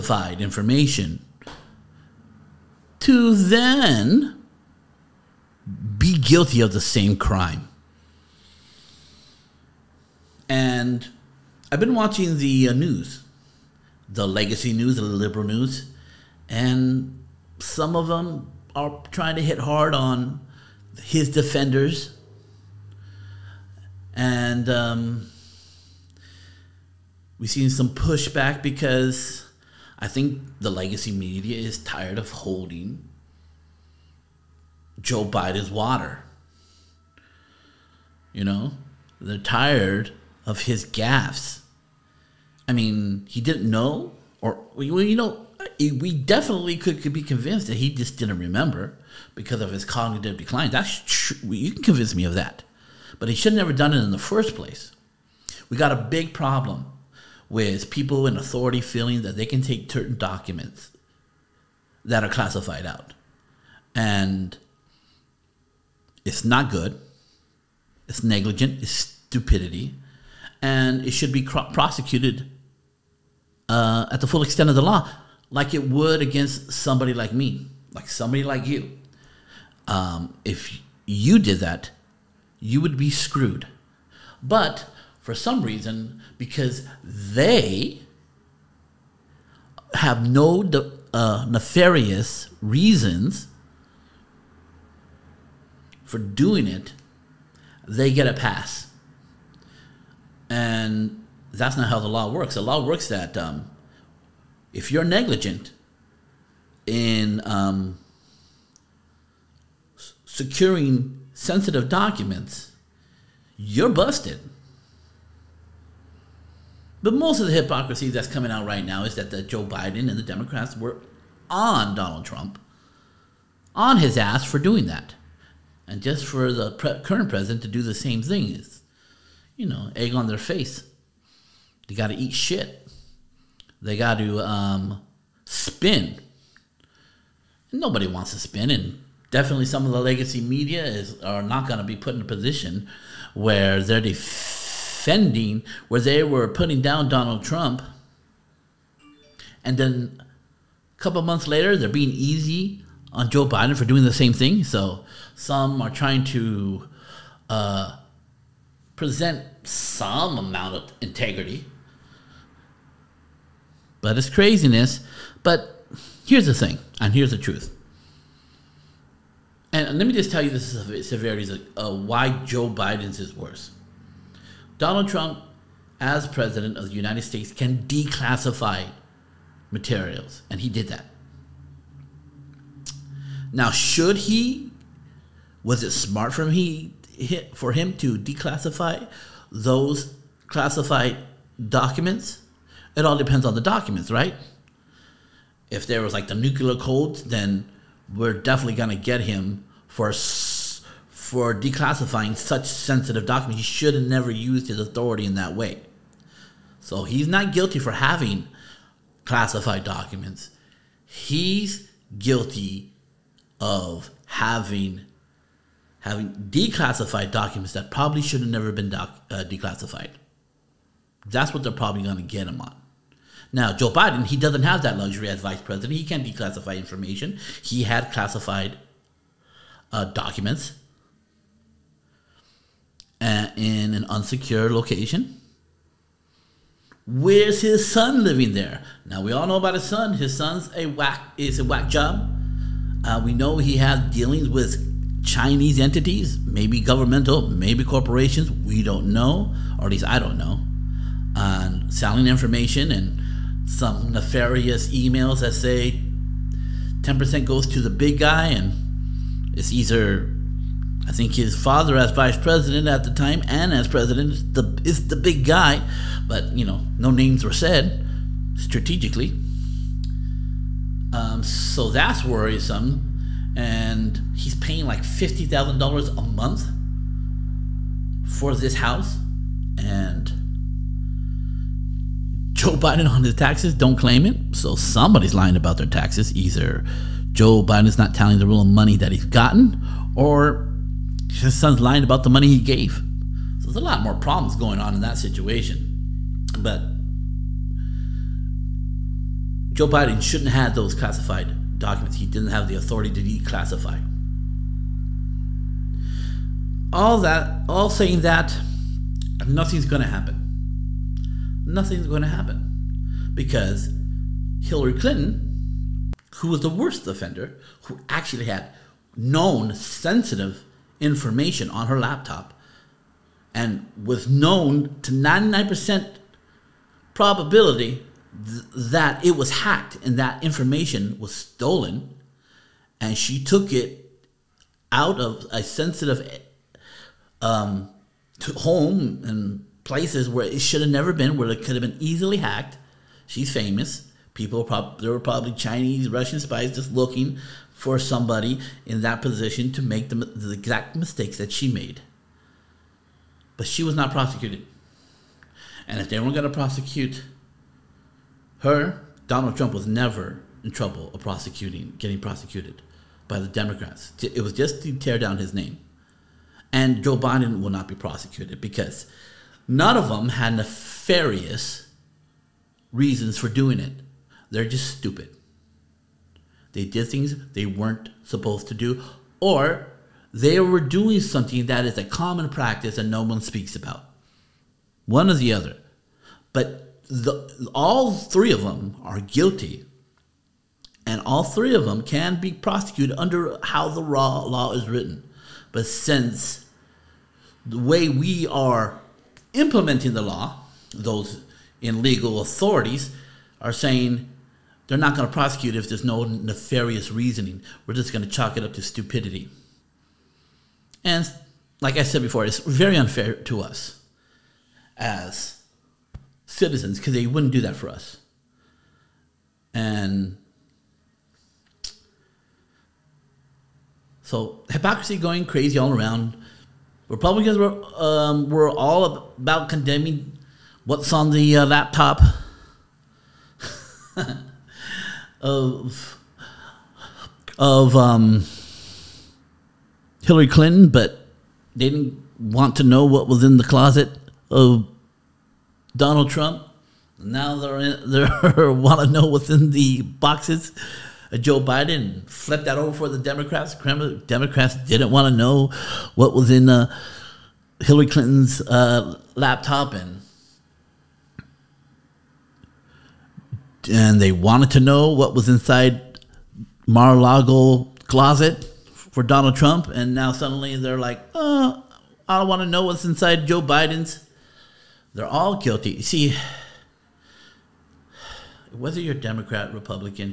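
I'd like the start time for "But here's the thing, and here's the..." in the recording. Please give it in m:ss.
2:45.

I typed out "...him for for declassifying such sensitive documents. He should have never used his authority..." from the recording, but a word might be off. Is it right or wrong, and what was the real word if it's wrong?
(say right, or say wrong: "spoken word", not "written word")
right.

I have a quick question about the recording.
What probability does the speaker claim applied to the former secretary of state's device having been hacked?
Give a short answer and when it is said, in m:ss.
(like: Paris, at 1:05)
99%, at 5:25.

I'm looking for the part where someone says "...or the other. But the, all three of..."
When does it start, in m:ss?
6:25.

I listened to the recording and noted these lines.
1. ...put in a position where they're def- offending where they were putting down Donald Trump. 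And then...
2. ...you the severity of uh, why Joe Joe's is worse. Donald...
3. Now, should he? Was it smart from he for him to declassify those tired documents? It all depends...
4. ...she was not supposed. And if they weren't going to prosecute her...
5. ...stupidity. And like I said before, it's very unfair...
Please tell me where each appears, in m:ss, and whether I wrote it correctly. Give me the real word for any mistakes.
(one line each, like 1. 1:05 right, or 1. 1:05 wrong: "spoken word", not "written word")
1. 2:21 right
2. 2:50 wrong: "Biden", not "Joe"
3. 3:03 wrong: "classified", not "tired"
4. 5:53 wrong: "prosecuted", not "supposed"
5. 6:48 right.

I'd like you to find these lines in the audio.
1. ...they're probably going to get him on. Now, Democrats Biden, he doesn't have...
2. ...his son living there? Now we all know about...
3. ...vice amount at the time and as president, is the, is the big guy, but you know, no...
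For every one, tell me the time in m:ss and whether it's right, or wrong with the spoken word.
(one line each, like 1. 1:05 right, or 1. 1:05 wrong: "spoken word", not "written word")
1. 3:41 wrong: "Joe", not "Democrats"
2. 3:57 right
3. 4:22 wrong: "president", not "amount".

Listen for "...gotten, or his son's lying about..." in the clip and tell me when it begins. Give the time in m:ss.
4:49.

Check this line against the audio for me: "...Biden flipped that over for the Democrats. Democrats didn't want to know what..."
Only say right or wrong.
right.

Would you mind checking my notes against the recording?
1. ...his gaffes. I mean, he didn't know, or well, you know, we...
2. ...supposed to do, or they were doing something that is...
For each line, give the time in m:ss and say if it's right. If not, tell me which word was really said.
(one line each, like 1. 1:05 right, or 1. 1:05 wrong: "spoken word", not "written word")
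1. 0:40 right
2. 6:18 right.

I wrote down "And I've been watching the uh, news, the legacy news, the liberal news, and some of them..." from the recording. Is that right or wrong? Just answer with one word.
right.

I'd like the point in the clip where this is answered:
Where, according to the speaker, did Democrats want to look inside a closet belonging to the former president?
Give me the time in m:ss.
7:46.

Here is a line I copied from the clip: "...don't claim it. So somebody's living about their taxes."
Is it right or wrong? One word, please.
wrong.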